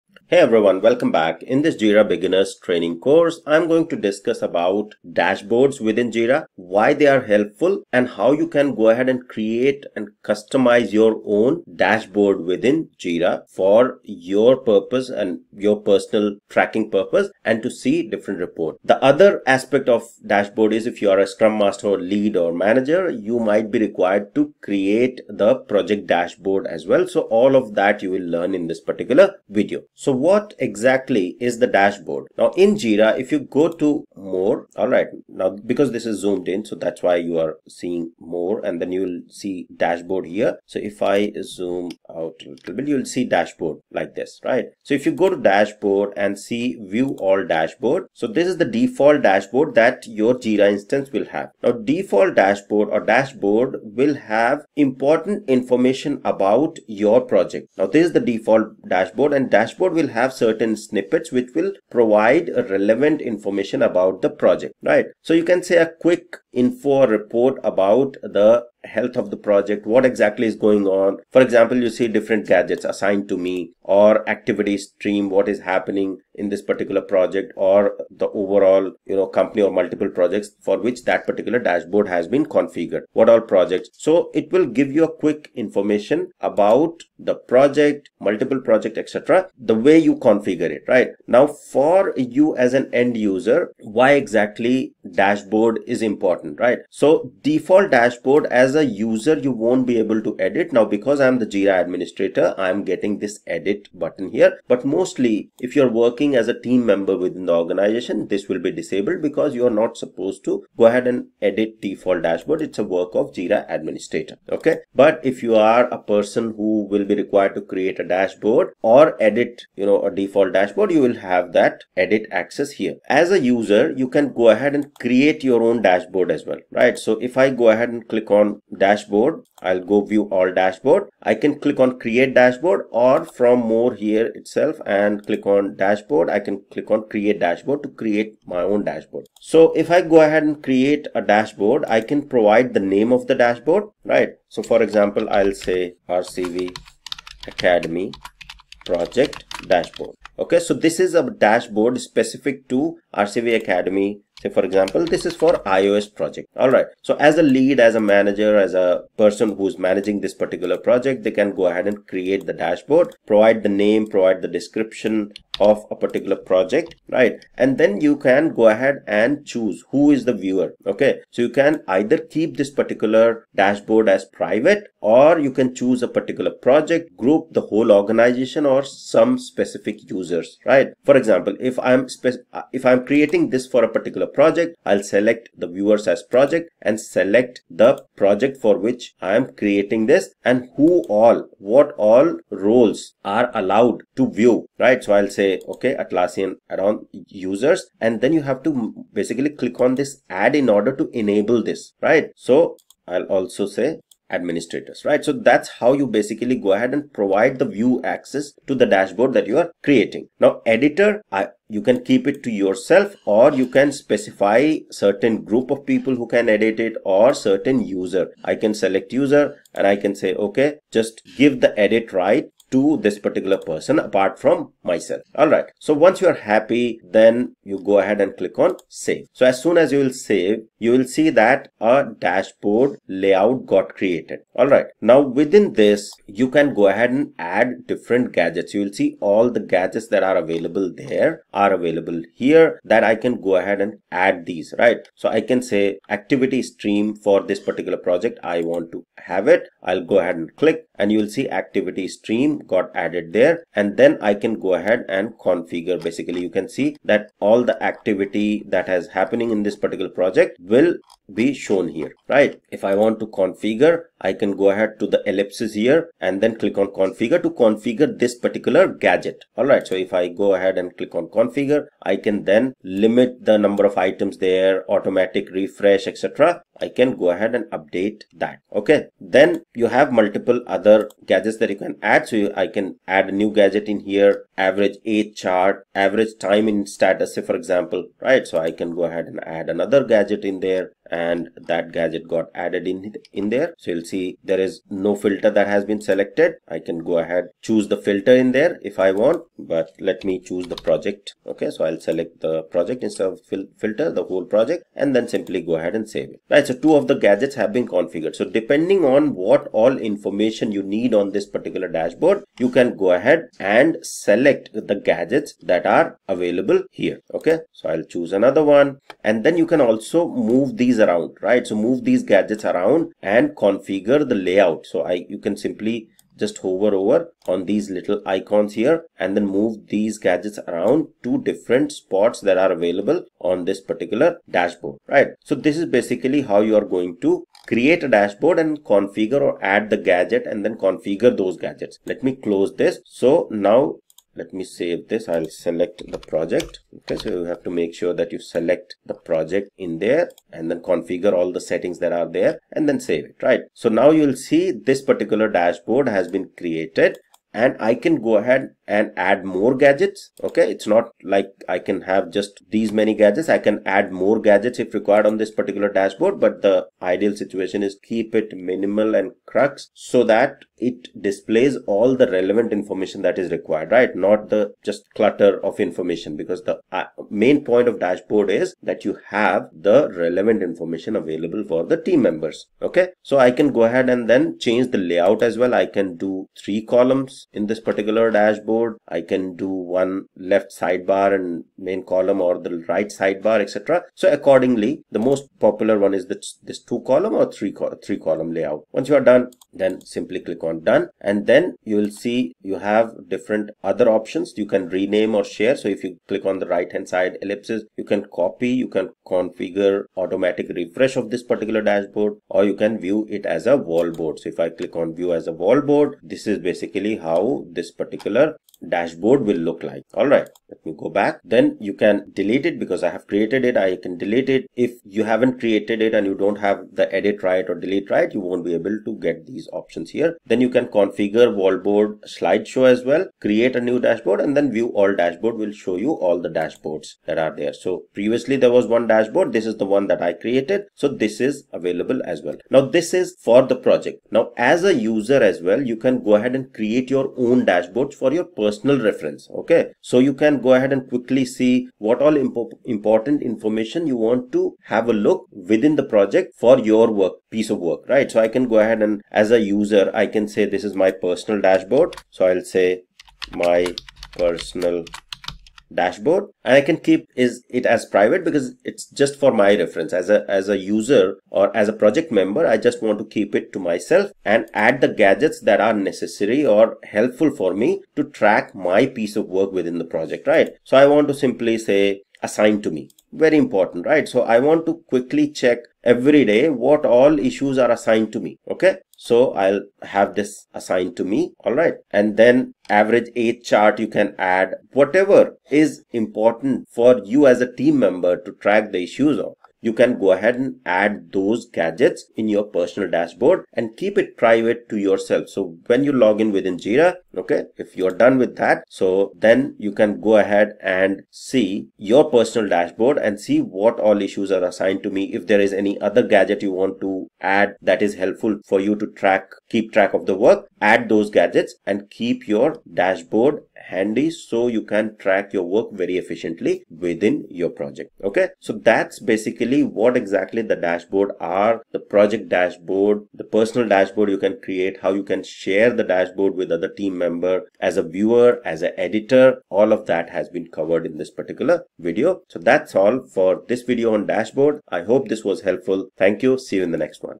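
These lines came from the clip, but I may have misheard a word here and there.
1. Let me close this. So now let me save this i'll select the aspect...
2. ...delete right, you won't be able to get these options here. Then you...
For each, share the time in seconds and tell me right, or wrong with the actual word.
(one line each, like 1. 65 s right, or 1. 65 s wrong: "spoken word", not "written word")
1. 342 s wrong: "project", not "aspect"
2. 427 s right.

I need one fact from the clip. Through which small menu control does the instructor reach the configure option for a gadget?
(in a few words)
The ellipsis.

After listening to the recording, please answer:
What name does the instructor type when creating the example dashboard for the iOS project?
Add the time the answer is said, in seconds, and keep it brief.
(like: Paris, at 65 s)
RCV Academy Project Dashboard, at 146 s.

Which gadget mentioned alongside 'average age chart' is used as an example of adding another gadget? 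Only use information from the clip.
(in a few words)
Average time in status.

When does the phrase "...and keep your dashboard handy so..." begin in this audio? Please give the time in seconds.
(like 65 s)
521 s.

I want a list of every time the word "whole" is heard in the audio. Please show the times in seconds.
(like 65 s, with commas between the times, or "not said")
177 s, 304 s.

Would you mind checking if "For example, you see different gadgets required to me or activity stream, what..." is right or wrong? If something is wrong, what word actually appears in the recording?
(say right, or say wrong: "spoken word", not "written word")
wrong: "assigned", not "required".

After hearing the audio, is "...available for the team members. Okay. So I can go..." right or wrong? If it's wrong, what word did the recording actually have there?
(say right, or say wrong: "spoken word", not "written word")
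right.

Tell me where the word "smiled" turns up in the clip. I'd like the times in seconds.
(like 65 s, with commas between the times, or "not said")
not said.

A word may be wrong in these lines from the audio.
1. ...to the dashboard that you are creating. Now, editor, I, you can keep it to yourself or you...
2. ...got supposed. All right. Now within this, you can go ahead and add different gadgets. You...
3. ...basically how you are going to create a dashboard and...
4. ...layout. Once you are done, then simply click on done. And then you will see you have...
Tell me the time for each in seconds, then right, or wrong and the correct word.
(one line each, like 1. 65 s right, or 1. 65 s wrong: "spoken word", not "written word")
1. 208 s right
2. 233 s wrong: "created", not "supposed"
3. 335 s right
4. 398 s right.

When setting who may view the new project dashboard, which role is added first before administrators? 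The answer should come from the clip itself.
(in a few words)
Atlassian add-on users.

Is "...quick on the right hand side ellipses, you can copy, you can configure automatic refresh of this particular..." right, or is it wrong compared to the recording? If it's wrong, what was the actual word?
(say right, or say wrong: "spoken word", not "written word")
wrong: "click", not "quick".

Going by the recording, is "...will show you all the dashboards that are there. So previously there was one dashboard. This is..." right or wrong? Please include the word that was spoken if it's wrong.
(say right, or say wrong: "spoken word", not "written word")
right.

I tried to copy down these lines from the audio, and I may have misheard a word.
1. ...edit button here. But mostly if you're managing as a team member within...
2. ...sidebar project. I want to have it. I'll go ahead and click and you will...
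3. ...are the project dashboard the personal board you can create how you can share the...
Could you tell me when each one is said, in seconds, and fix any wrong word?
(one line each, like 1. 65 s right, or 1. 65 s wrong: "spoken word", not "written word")
1. 103 s wrong: "working", not "managing"
2. 247 s wrong: "particular", not "sidebar"
3. 531 s wrong: "dashboard", not "board".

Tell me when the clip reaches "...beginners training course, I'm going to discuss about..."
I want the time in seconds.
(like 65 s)
2 s.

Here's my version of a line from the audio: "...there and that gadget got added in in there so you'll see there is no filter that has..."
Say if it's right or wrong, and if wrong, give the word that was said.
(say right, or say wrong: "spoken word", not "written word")
right.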